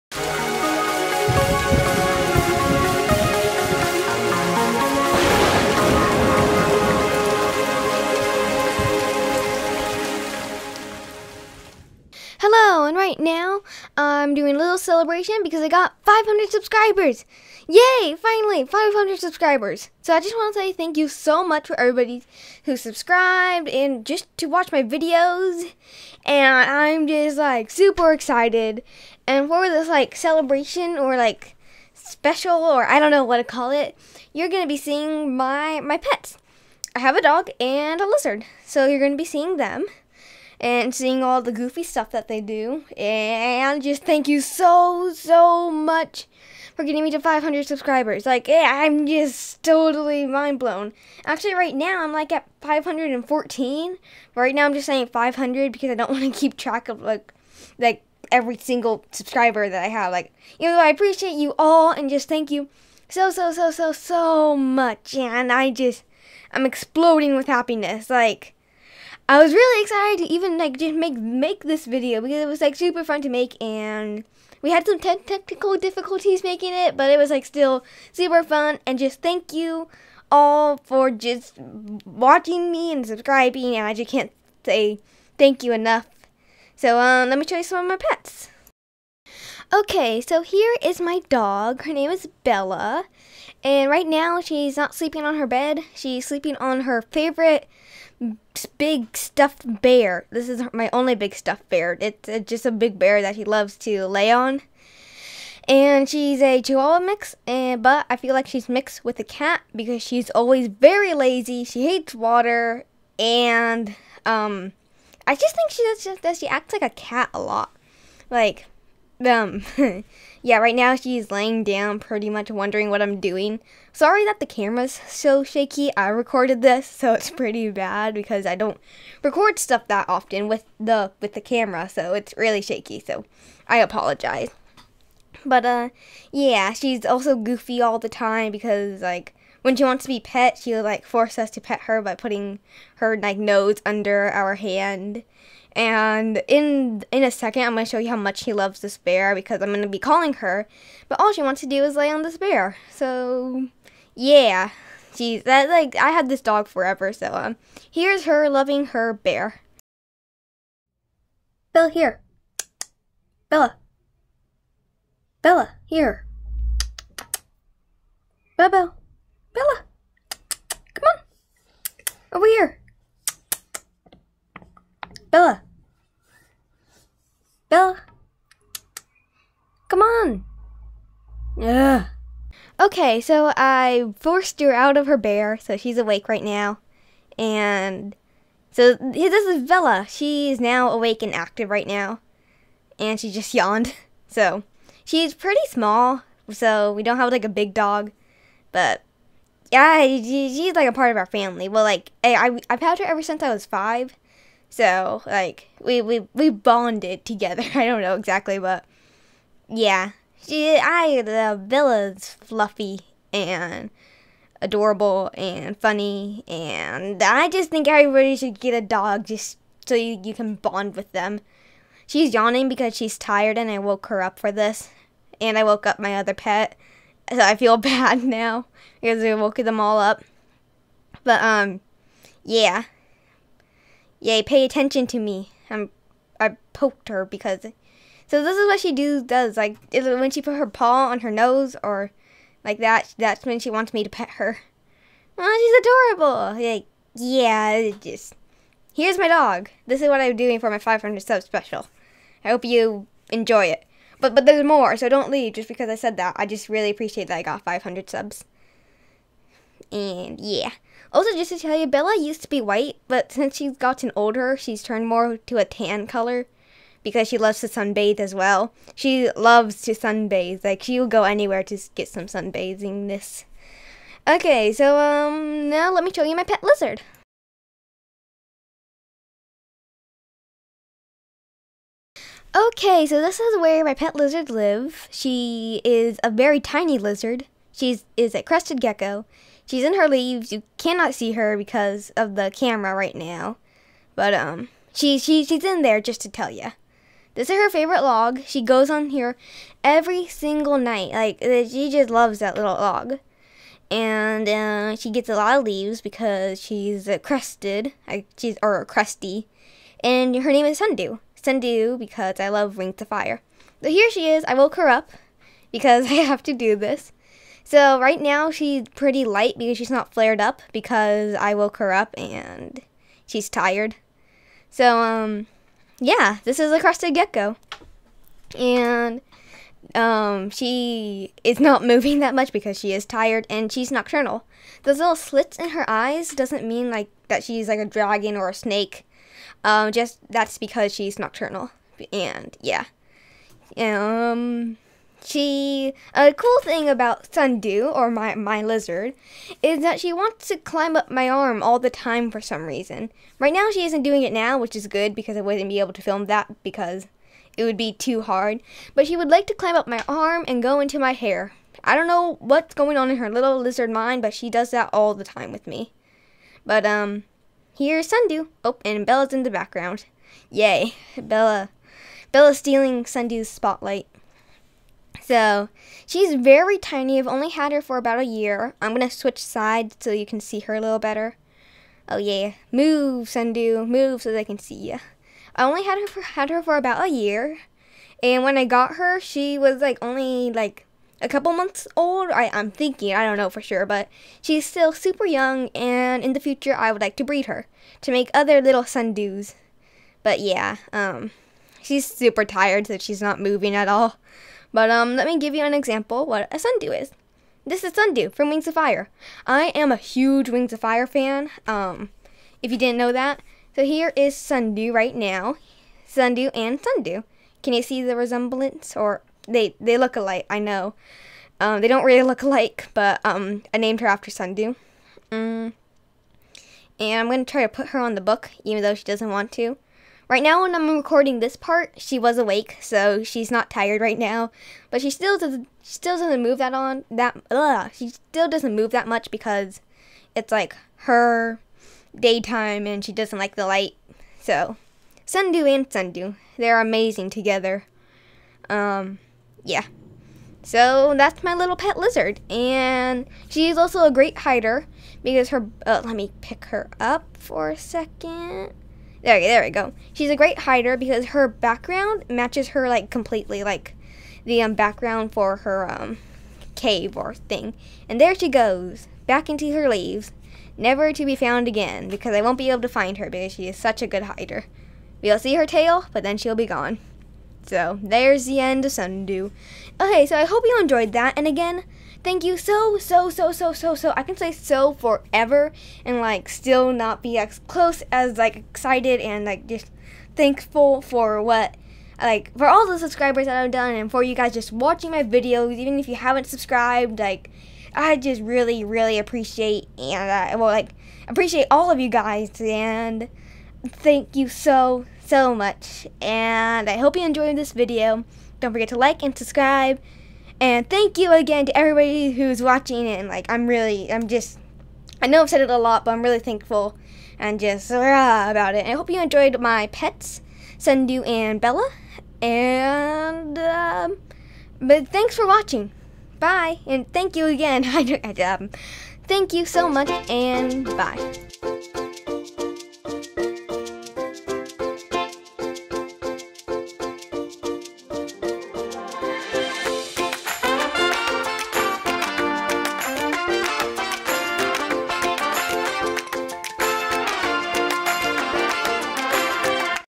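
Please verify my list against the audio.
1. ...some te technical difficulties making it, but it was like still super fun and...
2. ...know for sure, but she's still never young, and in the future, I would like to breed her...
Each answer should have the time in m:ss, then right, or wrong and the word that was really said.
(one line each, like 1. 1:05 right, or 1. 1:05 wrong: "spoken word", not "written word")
1. 1:14 right
2. 6:33 wrong: "super", not "never".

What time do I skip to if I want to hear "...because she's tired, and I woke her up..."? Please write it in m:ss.
3:42.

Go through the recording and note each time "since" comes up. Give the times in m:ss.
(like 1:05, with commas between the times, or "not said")
3:23, 4:23.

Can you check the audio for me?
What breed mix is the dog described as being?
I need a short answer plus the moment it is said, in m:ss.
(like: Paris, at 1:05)
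Chihuahua mix, at 1:46.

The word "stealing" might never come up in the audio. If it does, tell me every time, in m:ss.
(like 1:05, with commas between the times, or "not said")
6:12.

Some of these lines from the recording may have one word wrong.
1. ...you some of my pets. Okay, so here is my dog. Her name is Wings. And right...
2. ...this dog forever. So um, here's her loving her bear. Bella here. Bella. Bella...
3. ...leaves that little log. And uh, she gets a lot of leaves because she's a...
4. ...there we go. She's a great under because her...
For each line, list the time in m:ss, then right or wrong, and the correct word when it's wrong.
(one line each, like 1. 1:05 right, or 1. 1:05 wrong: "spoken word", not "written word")
1. 1:27 wrong: "Bella", not "Wings"
2. 2:36 right
3. 5:02 wrong: "loves", not "leaves"
4. 7:39 wrong: "hider", not "under".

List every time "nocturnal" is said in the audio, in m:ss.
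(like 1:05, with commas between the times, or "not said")
5:33, 5:41.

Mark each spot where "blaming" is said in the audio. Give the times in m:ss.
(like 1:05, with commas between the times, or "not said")
not said.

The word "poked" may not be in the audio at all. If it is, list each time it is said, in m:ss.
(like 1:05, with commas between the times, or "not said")
3:56.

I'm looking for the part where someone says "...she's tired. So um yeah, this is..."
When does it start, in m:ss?
5:23.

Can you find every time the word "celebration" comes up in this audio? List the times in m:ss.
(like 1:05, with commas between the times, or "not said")
0:14, 0:30.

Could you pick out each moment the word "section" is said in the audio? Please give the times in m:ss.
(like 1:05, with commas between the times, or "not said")
not said.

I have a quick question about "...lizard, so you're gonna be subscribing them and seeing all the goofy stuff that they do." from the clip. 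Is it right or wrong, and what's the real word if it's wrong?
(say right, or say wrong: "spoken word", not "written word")
wrong: "seeing", not "subscribing".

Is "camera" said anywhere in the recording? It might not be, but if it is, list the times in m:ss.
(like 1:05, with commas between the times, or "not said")
2:04, 2:11, 4:52.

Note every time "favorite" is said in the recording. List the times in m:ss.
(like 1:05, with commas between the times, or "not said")
1:37, 4:57.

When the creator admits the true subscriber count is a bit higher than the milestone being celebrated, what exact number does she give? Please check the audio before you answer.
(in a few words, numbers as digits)
514.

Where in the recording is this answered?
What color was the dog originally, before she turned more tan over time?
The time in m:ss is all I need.
4:22.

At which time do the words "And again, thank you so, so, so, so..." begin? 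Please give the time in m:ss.
8:01.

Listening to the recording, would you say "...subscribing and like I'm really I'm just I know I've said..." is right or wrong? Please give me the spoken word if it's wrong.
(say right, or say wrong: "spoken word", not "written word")
wrong: "watching", not "subscribing".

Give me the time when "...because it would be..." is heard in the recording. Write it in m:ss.
5:56.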